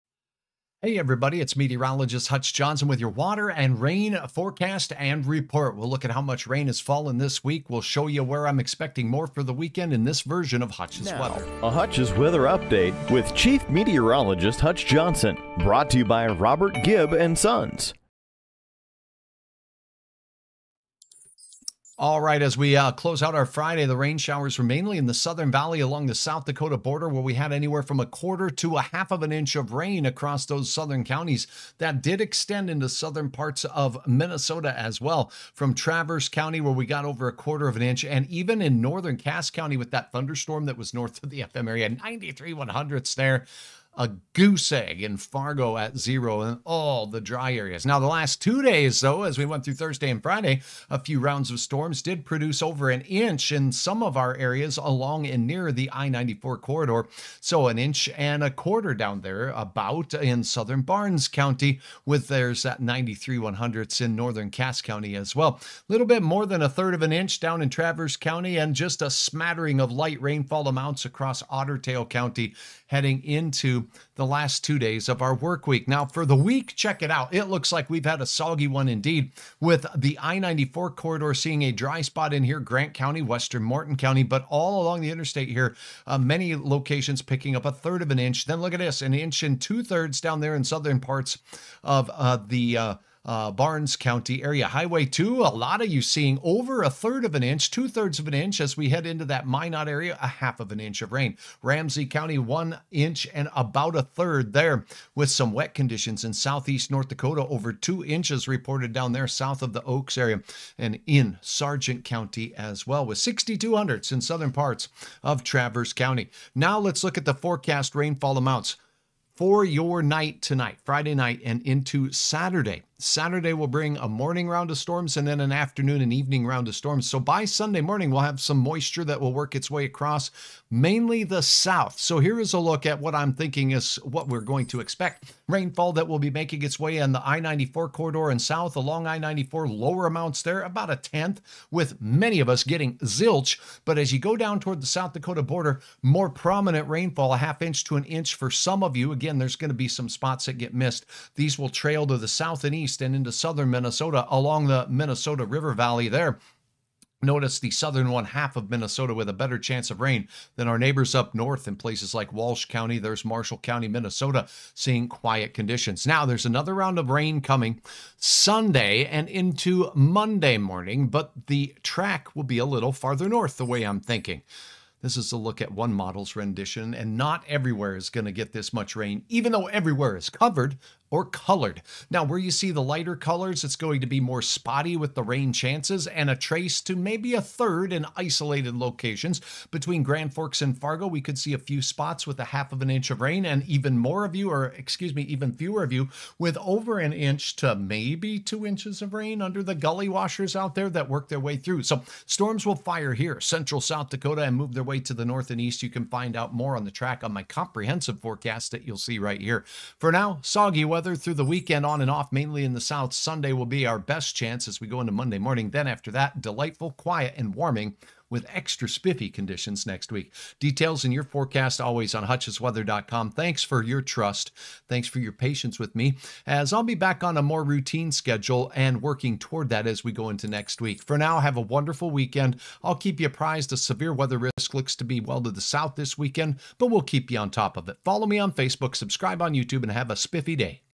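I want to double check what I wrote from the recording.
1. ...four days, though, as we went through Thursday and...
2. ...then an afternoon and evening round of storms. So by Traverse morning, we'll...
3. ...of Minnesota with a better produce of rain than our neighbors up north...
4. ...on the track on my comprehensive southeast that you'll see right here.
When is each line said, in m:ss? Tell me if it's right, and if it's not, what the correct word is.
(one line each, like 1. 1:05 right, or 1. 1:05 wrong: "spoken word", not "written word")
1. 0:48 wrong: "two", not "four"
2. 2:05 wrong: "Sunday", not "Traverse"
3. 2:38 wrong: "chance", not "produce"
4. 3:26 wrong: "forecast", not "southeast".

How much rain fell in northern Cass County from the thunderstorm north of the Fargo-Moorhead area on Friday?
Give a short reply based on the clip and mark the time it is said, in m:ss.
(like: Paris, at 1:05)
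0.93 inches, at 0:41.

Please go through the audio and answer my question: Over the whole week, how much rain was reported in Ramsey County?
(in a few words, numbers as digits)
1 1/3 inches.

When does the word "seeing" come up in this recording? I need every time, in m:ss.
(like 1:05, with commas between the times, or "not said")
1:21, 1:36, 2:44.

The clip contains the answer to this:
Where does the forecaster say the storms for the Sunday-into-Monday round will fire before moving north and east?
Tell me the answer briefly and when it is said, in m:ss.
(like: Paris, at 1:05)
central South Dakota, at 3:23.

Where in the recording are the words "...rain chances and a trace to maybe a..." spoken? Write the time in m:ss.
3:05.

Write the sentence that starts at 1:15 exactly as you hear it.
Now, for the week, check it out.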